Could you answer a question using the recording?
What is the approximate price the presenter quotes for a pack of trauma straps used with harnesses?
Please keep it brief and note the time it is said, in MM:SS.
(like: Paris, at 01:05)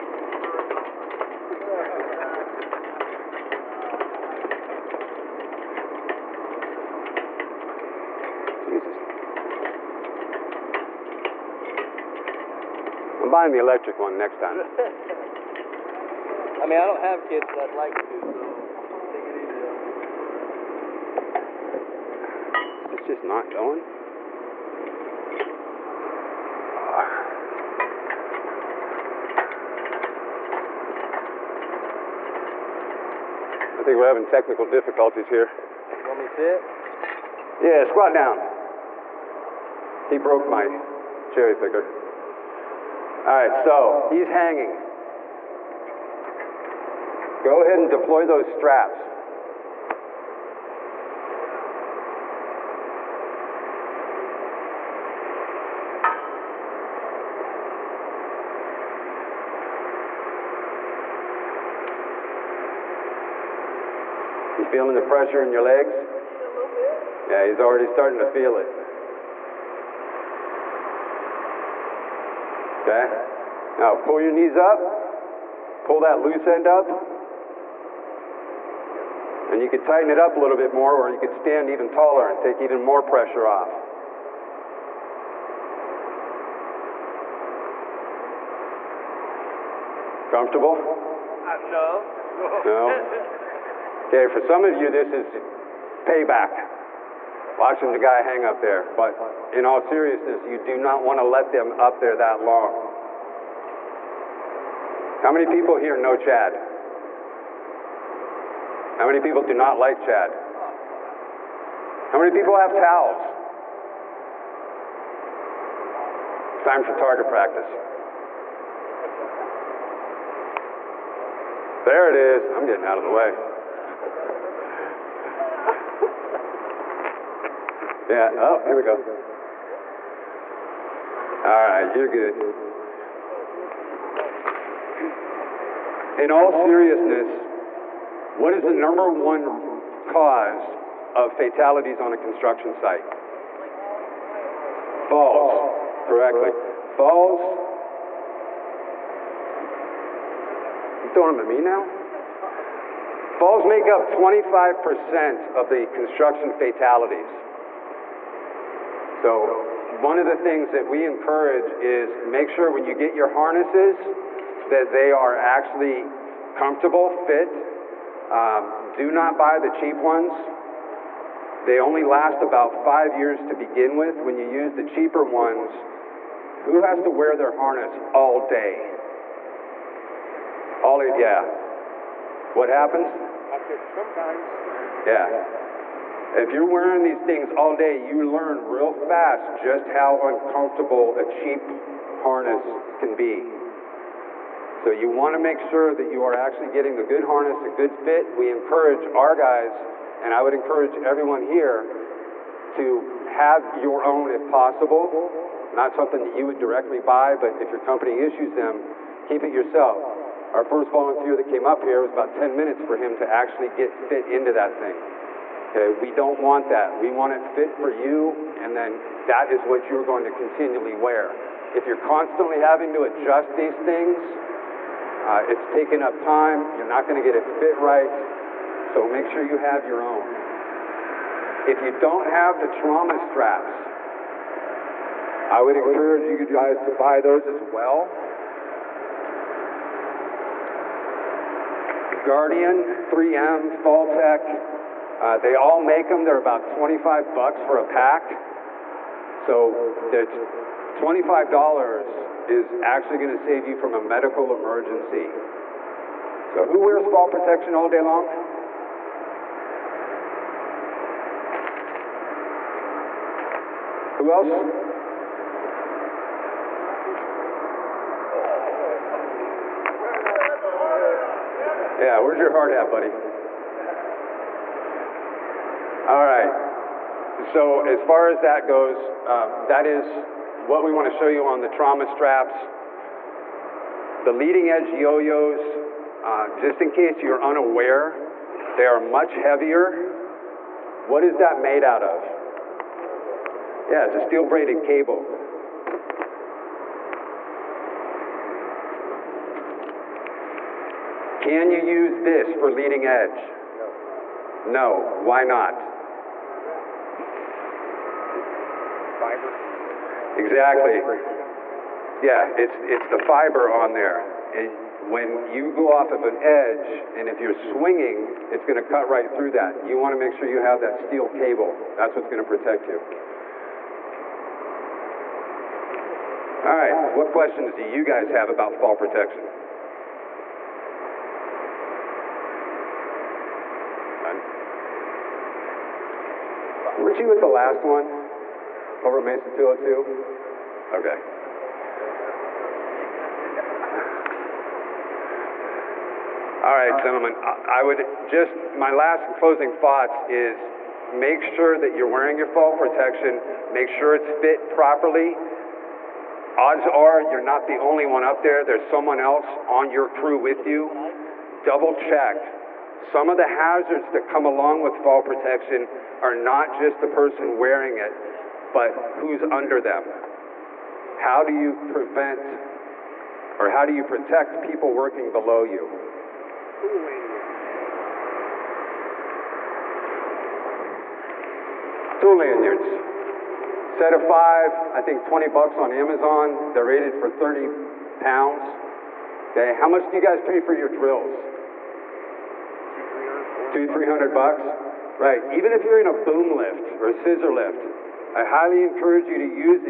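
$25, at 04:06.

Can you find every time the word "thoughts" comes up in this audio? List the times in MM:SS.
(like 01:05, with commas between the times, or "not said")
05:49.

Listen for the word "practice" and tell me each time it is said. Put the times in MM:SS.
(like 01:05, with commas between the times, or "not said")
01:57.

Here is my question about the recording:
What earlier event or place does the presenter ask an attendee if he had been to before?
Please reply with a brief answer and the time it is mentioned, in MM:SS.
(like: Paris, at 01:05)
Mason 202, at 05:39.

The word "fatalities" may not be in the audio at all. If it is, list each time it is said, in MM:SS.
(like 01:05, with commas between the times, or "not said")
02:21, 02:36.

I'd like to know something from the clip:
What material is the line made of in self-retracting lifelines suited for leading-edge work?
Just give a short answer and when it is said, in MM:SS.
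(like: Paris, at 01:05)
steel braided cable, at 04:54.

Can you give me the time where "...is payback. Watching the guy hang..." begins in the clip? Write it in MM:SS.
01:35.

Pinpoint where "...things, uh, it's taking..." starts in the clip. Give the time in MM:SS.
03:43.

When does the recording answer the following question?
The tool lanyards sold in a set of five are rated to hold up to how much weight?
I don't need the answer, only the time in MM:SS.
06:27.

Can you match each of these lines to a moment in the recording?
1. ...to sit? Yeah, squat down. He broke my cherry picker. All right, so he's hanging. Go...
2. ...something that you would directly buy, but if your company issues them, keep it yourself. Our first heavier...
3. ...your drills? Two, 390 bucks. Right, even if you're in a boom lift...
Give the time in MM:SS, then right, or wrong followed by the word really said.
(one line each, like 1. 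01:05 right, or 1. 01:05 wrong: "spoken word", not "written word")
1. 00:36 right
2. 03:25 wrong: "volunteer", not "heavier"
3. 06:30 wrong: "300", not "390".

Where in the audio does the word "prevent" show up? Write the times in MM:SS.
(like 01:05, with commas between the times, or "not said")
06:11.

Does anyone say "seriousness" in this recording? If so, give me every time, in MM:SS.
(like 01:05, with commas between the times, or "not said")
01:39, 02:16.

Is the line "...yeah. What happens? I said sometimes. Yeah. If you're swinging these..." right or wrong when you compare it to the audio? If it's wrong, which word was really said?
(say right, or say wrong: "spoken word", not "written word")
wrong: "wearing", not "swinging".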